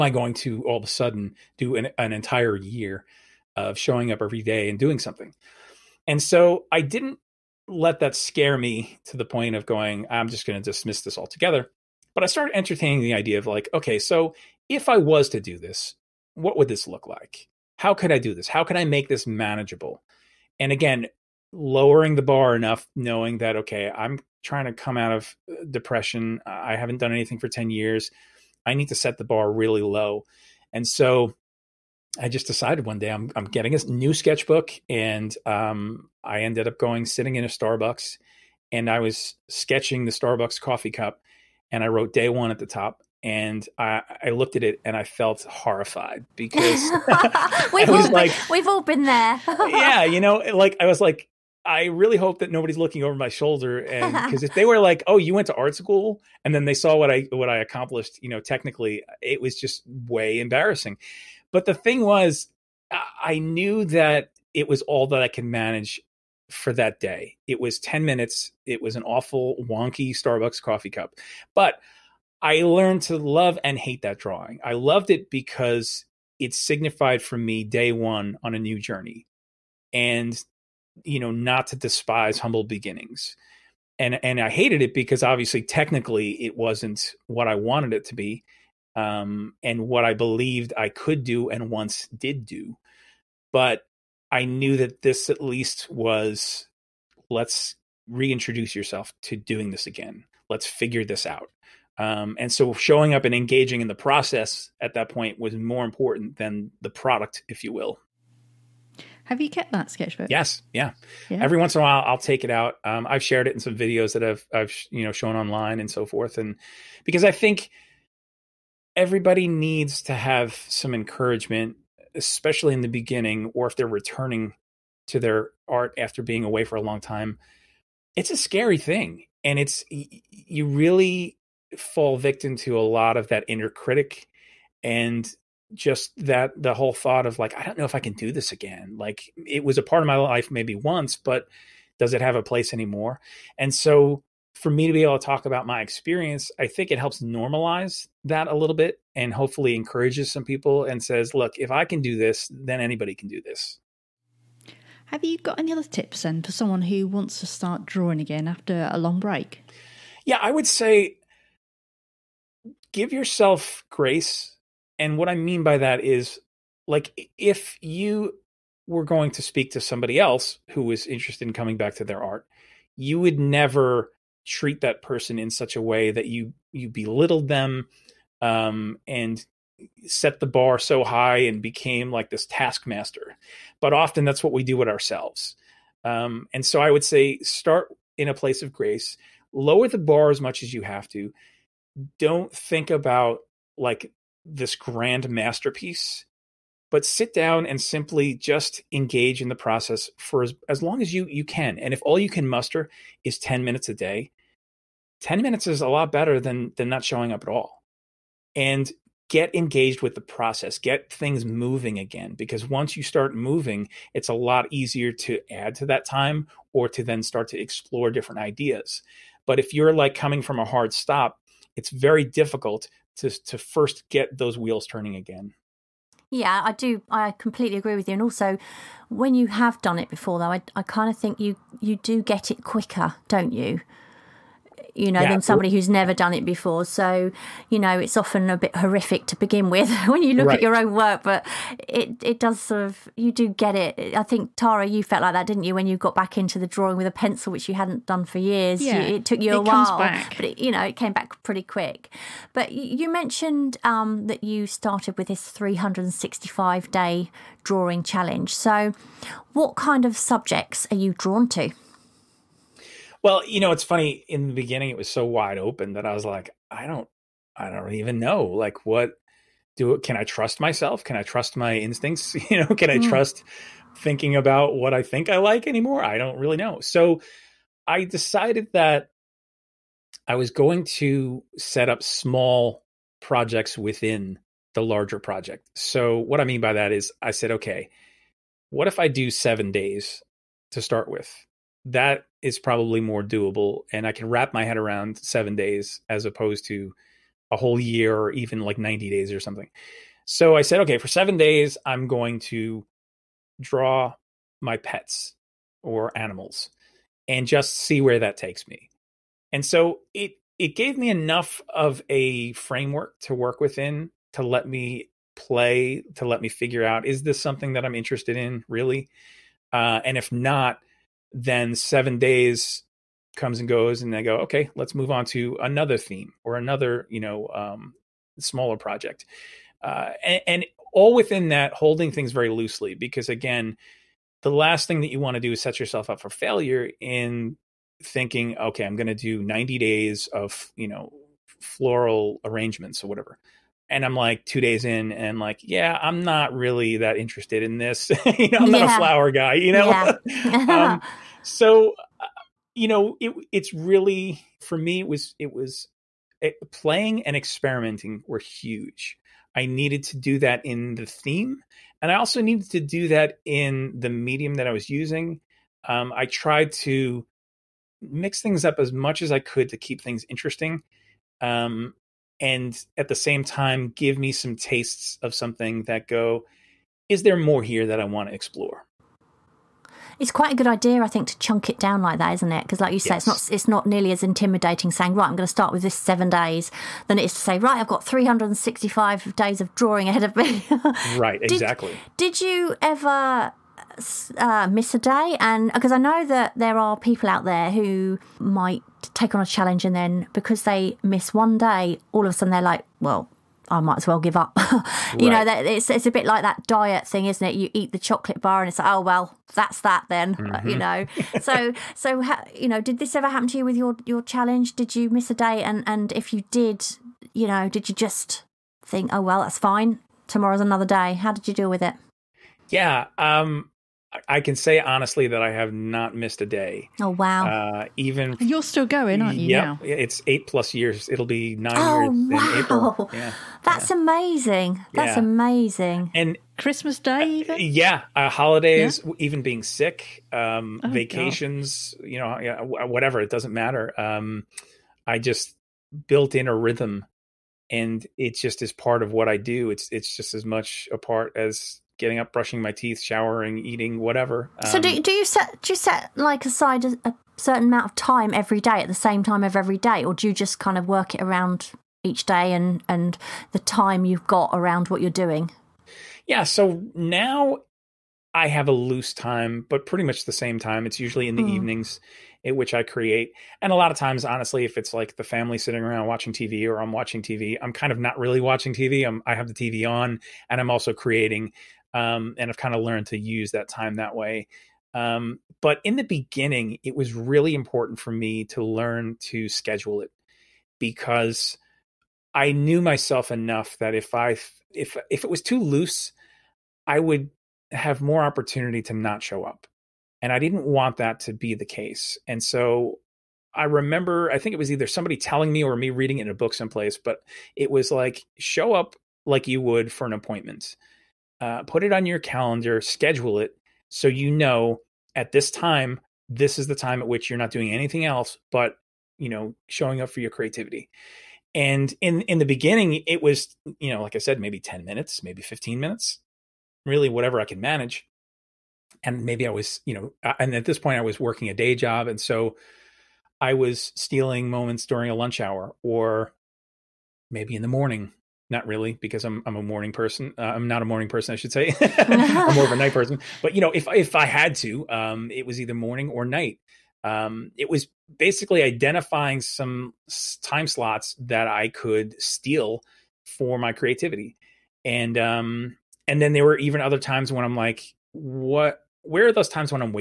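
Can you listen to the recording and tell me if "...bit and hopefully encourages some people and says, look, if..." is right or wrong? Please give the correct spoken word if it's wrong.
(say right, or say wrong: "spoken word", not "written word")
right.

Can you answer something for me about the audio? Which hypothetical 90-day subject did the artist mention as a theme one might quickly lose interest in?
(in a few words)
floral arrangements.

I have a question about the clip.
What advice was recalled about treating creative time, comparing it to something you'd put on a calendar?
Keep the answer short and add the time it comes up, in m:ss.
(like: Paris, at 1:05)
an appointment, at 8:30.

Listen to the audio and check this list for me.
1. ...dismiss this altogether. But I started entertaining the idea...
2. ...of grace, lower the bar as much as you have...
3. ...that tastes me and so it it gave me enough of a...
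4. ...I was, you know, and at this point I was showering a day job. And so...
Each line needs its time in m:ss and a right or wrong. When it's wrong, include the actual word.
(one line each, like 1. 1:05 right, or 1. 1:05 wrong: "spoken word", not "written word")
1. 0:10 right
2. 3:08 right
3. 5:08 wrong: "takes", not "tastes"
4. 8:49 wrong: "working", not "showering".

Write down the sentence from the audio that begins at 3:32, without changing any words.
Because once you start moving, it's a lot easier to add to that time or to then start to explore different ideas.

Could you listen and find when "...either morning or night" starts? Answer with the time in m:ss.
9:05.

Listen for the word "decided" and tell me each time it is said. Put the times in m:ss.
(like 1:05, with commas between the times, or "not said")
0:32, 4:38.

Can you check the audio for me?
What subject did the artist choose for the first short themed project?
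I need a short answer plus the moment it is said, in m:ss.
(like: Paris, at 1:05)
pets or animals, at 5:04.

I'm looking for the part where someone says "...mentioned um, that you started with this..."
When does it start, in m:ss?
4:13.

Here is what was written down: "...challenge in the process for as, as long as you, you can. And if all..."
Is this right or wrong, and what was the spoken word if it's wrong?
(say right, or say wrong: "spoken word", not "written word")
wrong: "engage", not "challenge".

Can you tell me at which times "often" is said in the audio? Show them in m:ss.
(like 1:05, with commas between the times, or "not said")
3:03, 3:58.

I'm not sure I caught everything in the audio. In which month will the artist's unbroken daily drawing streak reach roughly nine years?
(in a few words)
April.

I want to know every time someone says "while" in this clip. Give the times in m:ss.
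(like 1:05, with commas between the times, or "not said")
1:51, 4:09.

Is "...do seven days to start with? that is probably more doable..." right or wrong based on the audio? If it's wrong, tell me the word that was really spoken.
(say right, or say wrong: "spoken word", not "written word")
right.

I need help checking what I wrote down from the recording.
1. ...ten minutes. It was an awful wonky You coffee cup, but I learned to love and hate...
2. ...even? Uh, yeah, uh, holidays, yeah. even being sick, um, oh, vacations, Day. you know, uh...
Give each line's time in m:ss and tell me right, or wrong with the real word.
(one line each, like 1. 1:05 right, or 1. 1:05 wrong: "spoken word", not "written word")
1. 1:07 wrong: "Starbucks", not "You"
2. 7:17 wrong: "God", not "Day".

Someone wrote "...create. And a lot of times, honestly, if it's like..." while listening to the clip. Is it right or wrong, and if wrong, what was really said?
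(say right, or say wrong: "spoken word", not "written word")
right.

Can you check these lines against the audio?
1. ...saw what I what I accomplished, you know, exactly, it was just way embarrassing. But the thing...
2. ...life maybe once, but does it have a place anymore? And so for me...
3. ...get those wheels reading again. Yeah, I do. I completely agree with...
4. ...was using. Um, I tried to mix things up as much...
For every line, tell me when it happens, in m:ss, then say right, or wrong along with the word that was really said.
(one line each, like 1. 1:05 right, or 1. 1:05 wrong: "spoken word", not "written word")
1. 0:56 wrong: "technically", not "exactly"
2. 2:20 right
3. 3:44 wrong: "turning", not "reading"
4. 6:04 right.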